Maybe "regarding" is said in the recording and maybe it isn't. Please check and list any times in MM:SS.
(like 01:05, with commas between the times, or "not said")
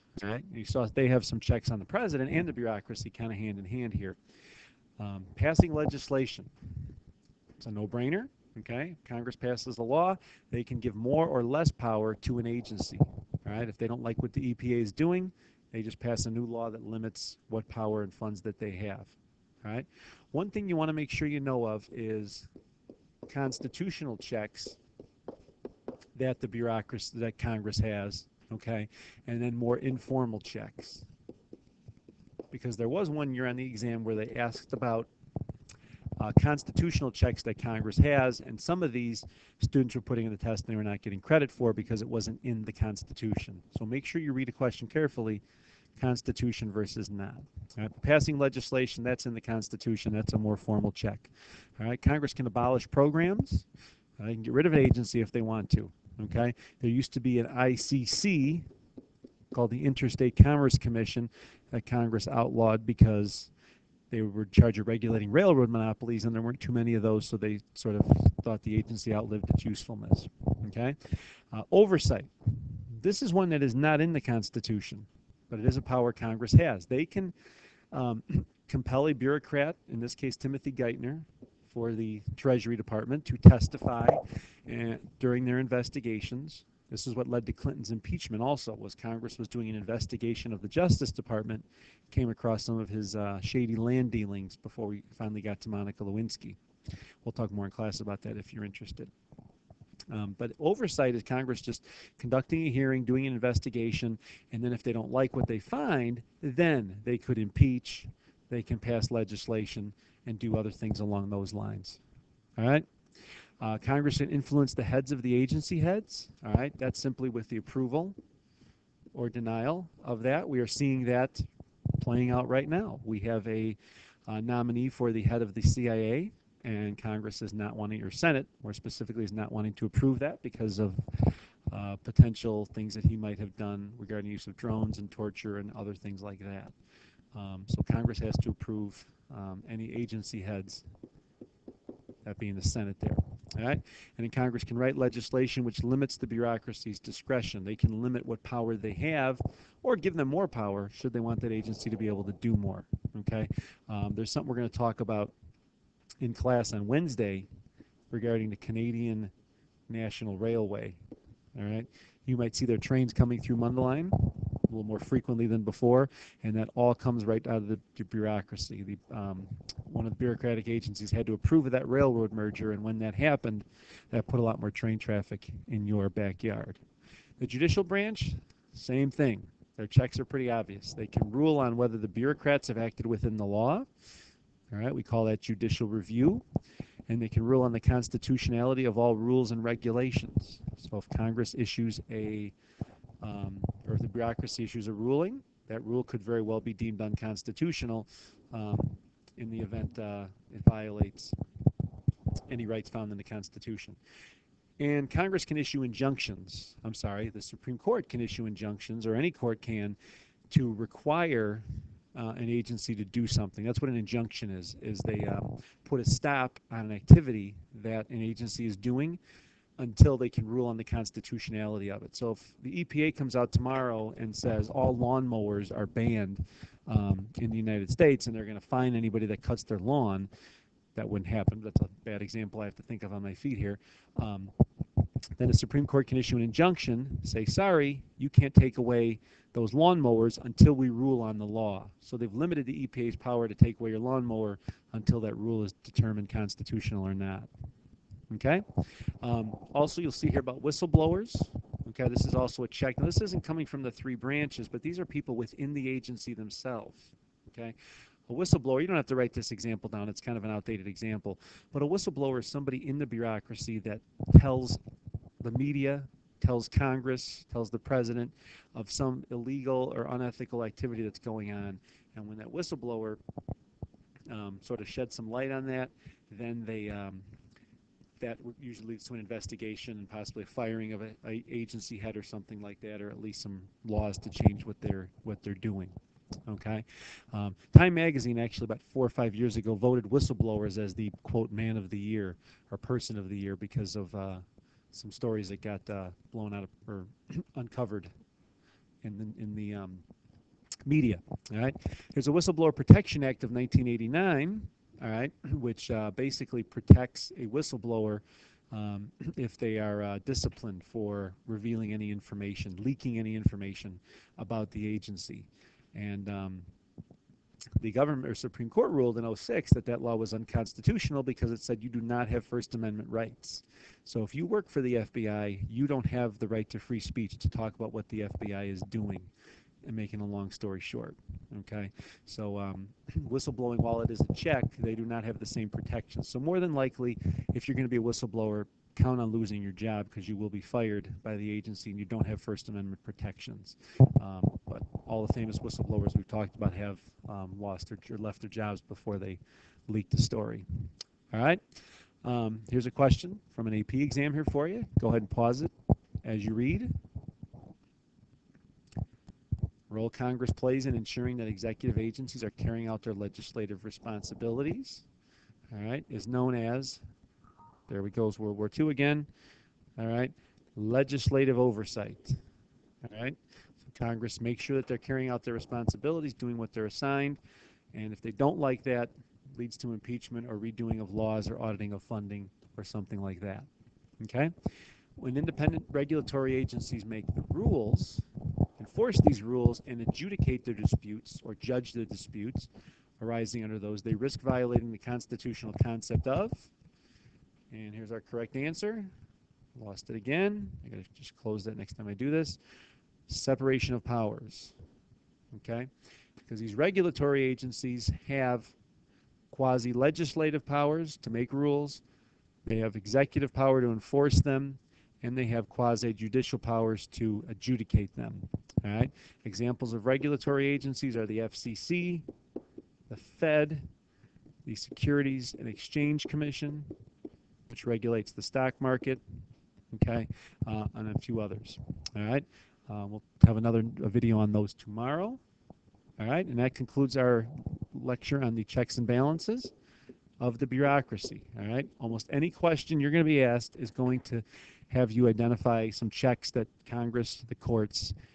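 02:13, 02:38.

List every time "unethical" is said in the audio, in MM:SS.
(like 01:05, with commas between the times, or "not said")
04:30.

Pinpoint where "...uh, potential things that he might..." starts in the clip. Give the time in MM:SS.
02:11.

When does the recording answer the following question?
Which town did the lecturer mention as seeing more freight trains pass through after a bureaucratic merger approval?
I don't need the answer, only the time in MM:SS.
02:43.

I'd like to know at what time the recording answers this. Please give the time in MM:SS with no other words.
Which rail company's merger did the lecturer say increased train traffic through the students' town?
02:38.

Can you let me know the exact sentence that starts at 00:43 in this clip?
So make sure you read a question carefully Constitution versus not.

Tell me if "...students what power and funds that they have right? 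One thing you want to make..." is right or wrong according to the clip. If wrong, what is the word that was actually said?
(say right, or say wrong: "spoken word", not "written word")
wrong: "limits", not "students".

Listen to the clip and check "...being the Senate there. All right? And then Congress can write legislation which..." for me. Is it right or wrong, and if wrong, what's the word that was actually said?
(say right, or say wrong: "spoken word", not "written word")
right.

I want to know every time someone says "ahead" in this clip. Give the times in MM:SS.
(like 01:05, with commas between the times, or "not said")
05:55.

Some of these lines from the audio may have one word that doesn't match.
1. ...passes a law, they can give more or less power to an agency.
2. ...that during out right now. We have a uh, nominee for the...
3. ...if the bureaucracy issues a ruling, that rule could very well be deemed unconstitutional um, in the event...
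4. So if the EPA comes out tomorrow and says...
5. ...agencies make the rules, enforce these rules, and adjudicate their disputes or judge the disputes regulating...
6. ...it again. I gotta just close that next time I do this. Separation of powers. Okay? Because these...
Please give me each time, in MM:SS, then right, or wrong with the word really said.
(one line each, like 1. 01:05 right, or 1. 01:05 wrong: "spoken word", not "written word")
1. 00:09 right
2. 02:01 wrong: "playing", not "during"
3. 03:13 right
4. 03:42 right
5. 06:26 wrong: "arising", not "regulating"
6. 06:40 right.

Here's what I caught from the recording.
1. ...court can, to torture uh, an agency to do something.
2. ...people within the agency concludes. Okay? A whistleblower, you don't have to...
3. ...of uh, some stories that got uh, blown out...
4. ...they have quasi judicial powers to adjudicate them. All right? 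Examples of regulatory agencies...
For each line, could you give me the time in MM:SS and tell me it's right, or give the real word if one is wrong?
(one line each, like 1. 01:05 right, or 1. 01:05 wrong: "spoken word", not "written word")
1. 03:29 wrong: "require", not "torture"
2. 04:15 wrong: "themselves", not "concludes"
3. 04:53 right
4. 06:55 right.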